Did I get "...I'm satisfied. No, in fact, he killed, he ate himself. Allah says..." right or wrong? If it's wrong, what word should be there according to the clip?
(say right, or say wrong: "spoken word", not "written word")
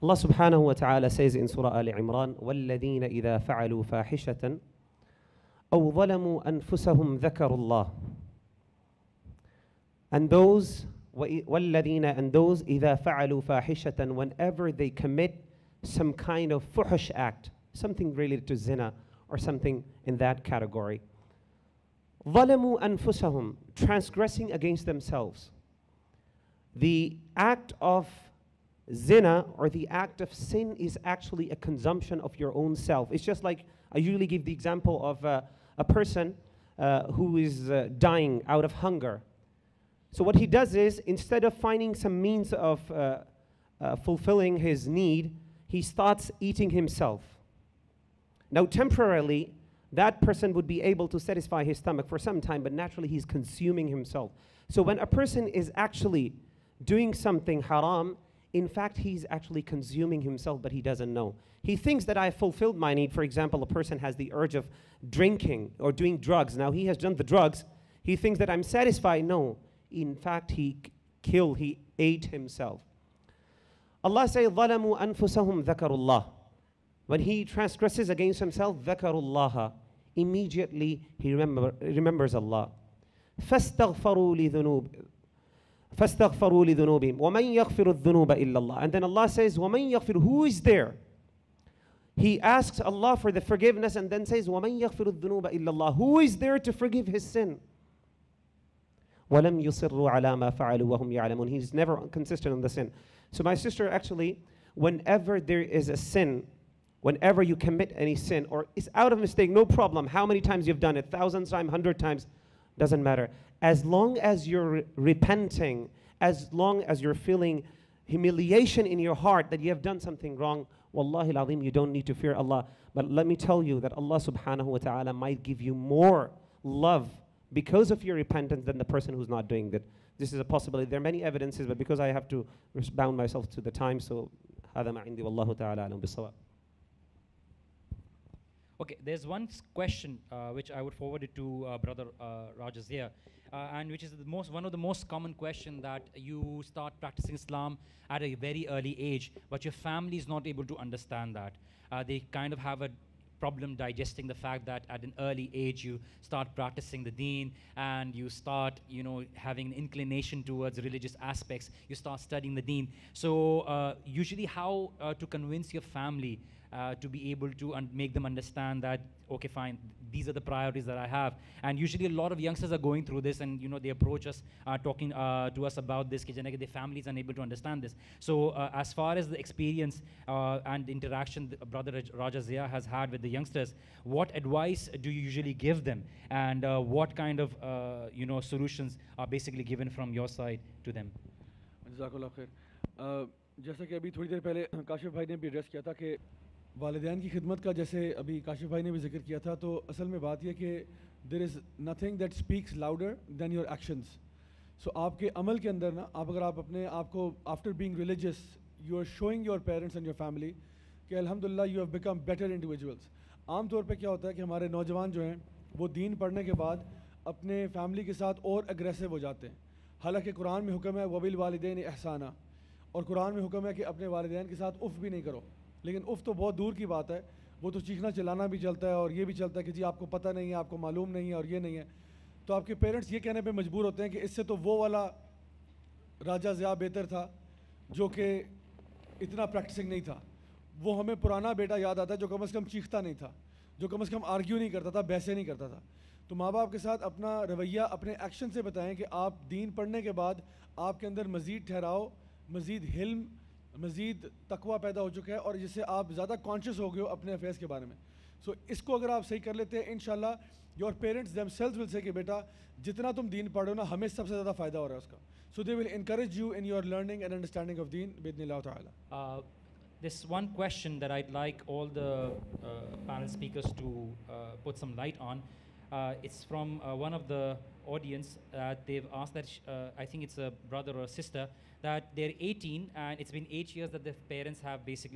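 right.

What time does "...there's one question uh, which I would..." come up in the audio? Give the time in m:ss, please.
2:19.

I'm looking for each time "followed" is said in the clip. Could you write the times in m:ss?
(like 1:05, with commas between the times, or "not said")
not said.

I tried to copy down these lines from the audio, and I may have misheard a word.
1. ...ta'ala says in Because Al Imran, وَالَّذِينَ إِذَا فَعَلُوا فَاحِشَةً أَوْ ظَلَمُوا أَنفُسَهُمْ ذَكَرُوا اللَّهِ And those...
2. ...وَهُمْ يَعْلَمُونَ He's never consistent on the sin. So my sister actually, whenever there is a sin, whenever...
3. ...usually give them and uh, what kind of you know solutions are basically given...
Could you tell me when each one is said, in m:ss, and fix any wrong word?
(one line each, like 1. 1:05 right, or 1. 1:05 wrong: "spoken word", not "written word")
1. 0:00 wrong: "Surah", not "Because"
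2. 1:40 right
3. 3:05 right.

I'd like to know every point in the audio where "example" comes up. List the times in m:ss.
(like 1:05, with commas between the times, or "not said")
0:34, 1:03.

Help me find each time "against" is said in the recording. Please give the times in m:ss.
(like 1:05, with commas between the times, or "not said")
0:24, 1:18.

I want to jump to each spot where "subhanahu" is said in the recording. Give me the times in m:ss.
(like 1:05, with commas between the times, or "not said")
0:00, 2:04.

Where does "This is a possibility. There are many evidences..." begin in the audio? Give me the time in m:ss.
2:10.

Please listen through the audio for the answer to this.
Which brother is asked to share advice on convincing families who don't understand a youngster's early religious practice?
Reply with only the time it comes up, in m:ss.
3:02.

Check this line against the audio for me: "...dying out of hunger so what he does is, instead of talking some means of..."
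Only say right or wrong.
wrong.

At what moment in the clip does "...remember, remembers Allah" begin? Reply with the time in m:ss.
1:21.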